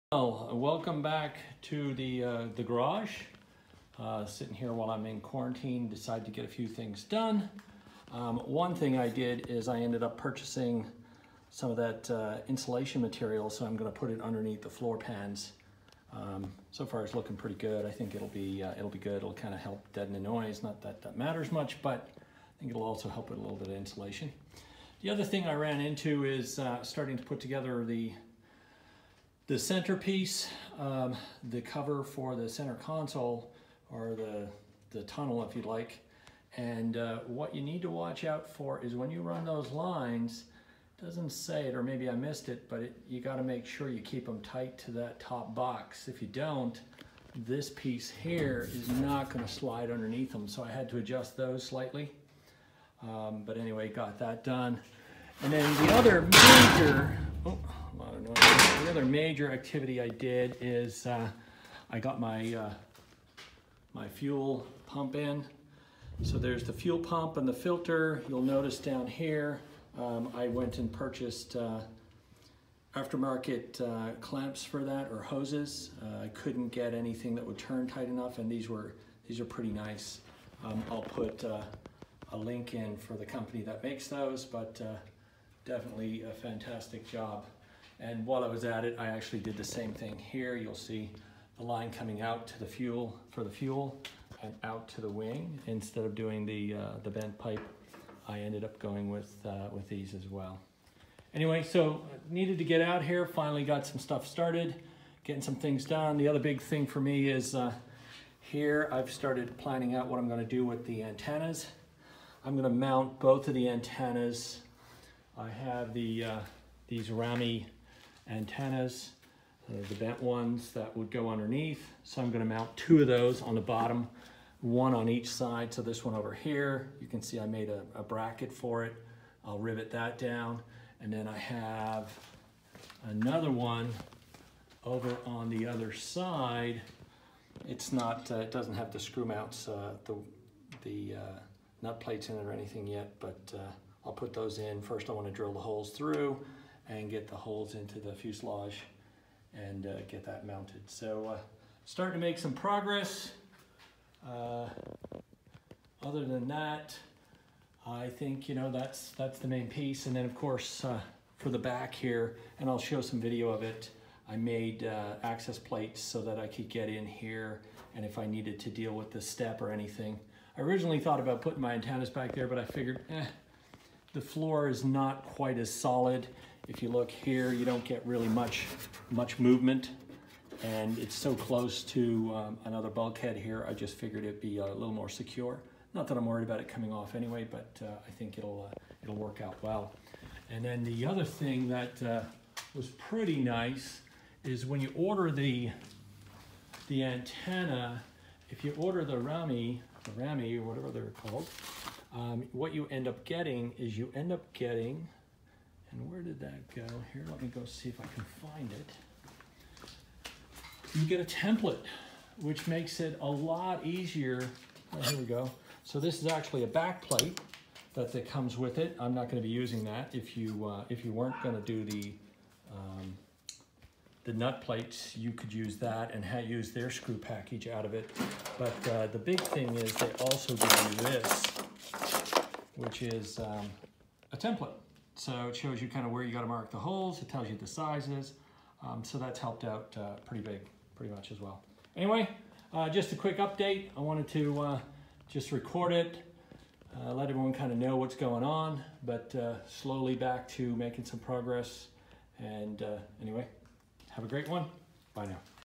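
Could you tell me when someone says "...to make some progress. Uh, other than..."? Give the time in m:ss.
2:32.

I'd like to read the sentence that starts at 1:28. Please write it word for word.
And while I was at it, I actually did the same thing here.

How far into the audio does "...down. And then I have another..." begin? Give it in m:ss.
2:10.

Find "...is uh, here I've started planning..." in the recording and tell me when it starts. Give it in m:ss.
1:47.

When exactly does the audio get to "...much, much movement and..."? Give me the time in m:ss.
2:58.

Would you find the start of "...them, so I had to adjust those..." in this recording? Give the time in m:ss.
0:50.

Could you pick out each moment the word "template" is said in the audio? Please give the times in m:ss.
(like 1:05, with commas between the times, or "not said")
3:31, 3:54.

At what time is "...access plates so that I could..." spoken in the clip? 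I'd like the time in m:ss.
2:45.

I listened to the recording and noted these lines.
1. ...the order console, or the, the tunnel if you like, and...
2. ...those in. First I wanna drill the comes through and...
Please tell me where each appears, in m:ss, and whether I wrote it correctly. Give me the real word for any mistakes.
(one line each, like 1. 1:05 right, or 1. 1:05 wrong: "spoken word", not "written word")
1. 0:32 wrong: "center", not "order"
2. 2:24 wrong: "holes", not "comes".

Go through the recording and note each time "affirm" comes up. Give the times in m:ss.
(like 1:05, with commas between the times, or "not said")
not said.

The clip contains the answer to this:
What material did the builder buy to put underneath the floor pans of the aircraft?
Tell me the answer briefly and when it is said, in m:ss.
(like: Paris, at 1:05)
Insulation material, at 0:12.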